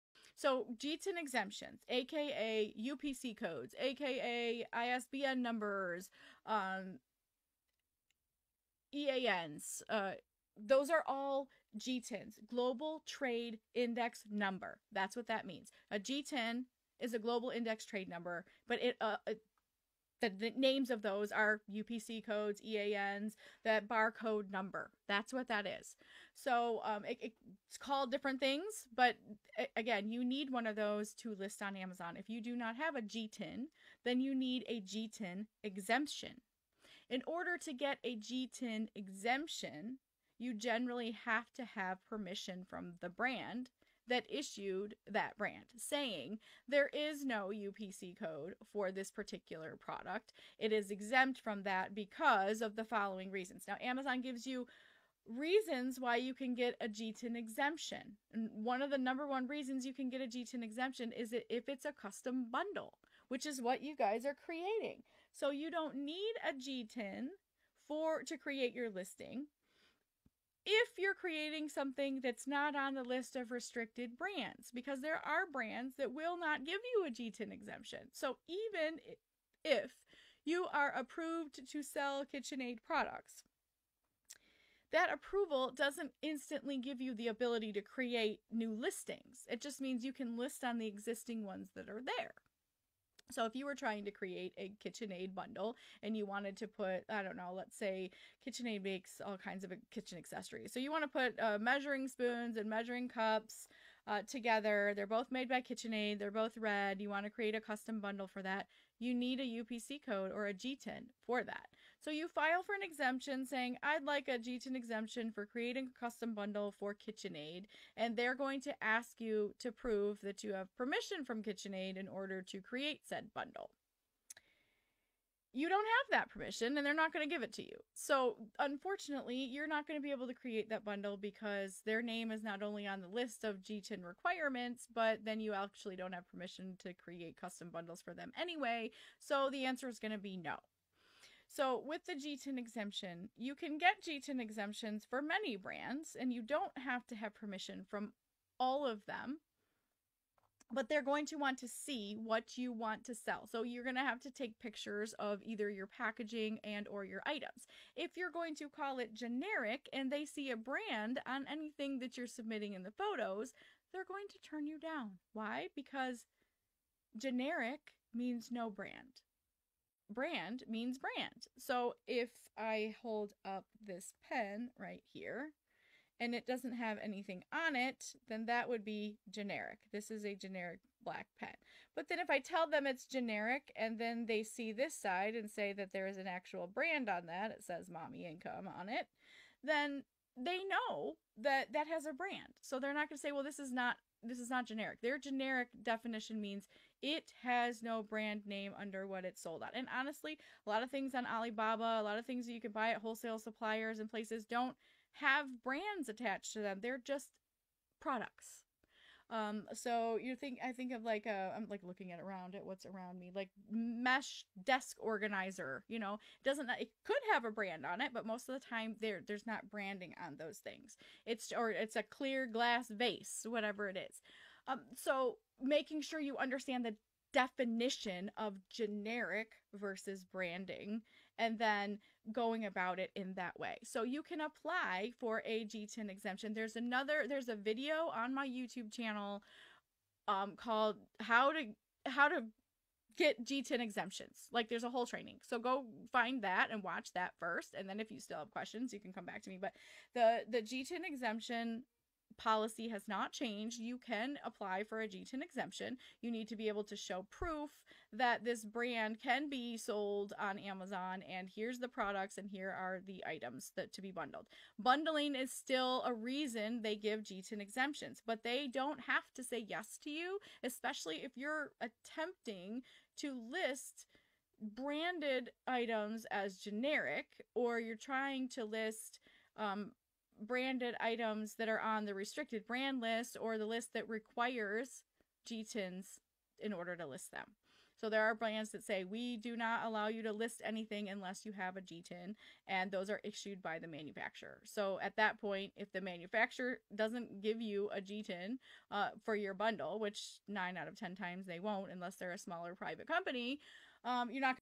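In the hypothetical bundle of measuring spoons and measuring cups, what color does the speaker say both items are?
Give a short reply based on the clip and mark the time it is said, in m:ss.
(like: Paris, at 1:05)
Red, at 1:46.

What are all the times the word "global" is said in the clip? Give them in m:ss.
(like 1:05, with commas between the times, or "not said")
0:12, 0:17.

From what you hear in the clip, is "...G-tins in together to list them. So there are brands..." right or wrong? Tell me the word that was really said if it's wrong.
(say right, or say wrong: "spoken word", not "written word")
wrong: "order", not "together".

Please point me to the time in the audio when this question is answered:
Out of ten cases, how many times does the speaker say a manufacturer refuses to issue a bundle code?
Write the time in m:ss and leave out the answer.
5:00.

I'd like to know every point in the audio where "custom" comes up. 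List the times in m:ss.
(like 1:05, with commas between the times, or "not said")
1:01, 1:47, 1:55, 2:17.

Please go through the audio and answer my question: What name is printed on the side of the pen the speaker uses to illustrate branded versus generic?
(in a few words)
Mommy Income.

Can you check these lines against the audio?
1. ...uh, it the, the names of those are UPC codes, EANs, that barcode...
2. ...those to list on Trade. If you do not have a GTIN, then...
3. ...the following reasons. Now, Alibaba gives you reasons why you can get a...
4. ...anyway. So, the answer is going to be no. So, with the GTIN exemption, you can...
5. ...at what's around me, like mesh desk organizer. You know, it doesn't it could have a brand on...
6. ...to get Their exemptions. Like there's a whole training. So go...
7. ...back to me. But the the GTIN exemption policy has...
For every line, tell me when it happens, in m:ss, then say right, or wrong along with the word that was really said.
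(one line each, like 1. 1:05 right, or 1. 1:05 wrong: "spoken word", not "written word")
1. 0:18 right
2. 0:30 wrong: "Amazon", not "Trade"
3. 0:52 wrong: "Amazon", not "Alibaba"
4. 2:18 right
5. 3:32 right
6. 4:02 wrong: "GTIN", not "Their"
7. 4:09 right.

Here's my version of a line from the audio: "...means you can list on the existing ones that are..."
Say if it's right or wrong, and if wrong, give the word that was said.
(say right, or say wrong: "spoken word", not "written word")
right.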